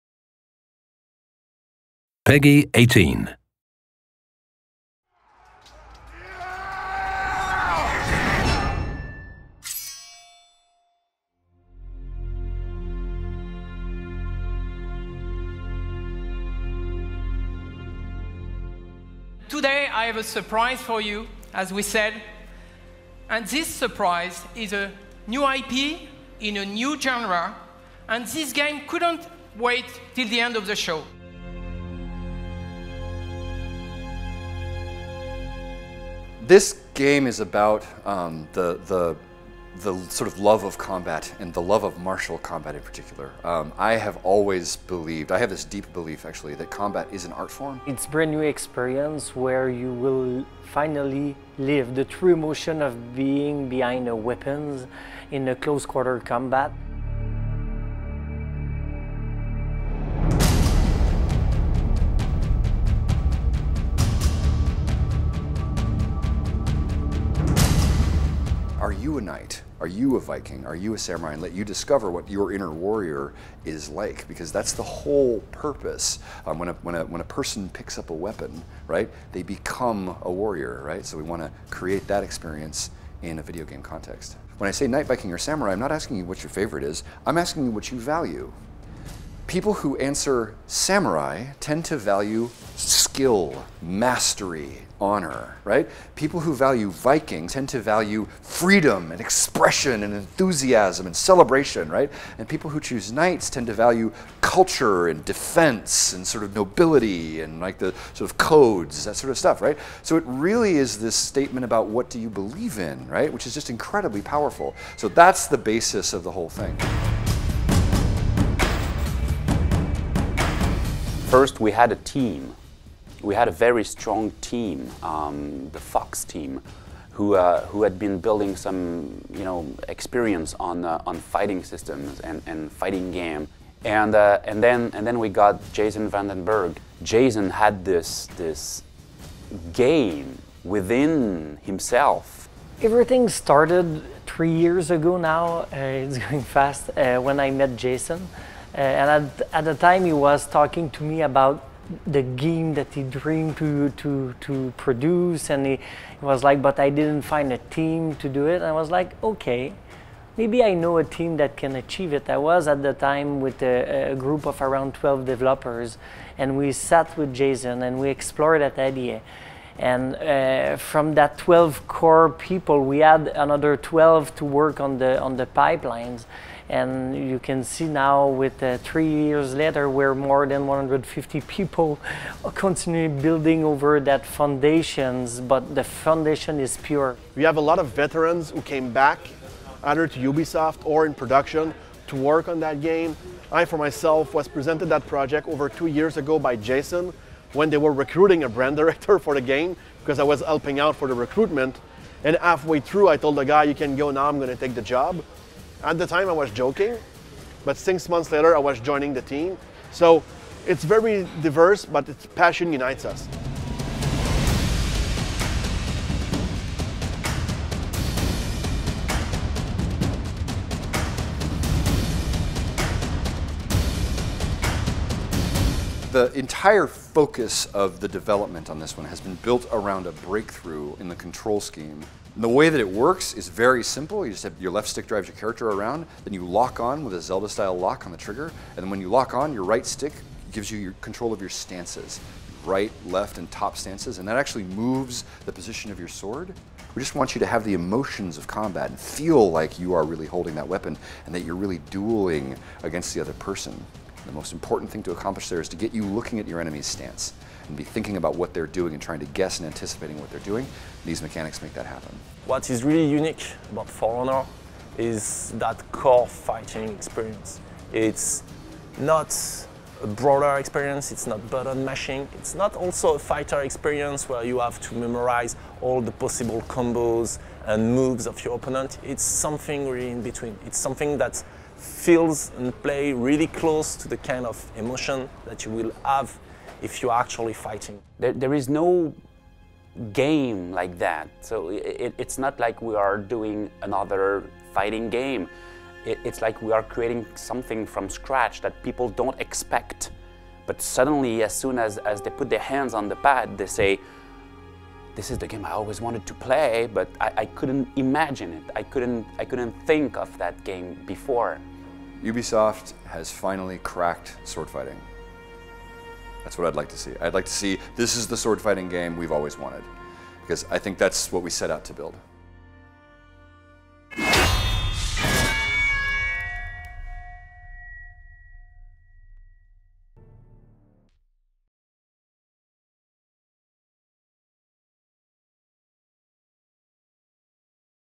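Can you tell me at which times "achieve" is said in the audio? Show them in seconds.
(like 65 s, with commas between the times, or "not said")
161 s.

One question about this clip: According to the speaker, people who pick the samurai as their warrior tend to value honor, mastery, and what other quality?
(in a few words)
skill.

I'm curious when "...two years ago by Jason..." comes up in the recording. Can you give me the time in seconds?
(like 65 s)
195 s.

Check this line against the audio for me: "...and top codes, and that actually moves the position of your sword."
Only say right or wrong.
wrong.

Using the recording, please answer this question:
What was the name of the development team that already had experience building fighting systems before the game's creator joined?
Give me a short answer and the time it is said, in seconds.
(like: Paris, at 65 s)
the Fox team, at 125 s.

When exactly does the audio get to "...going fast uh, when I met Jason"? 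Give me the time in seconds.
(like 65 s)
146 s.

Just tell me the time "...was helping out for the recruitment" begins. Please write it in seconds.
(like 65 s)
200 s.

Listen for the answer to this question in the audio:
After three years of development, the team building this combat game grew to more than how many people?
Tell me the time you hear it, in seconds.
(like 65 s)
180 s.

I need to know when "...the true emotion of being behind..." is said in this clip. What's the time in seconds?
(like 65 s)
51 s.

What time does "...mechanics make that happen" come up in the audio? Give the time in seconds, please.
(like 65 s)
261 s.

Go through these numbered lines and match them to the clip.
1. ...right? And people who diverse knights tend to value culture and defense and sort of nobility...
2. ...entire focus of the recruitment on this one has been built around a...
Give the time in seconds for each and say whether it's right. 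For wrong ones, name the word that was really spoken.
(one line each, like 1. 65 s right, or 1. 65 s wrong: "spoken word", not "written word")
1. 101 s wrong: "choose", not "diverse"
2. 226 s wrong: "development", not "recruitment".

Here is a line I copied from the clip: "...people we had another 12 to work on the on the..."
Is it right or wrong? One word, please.
right.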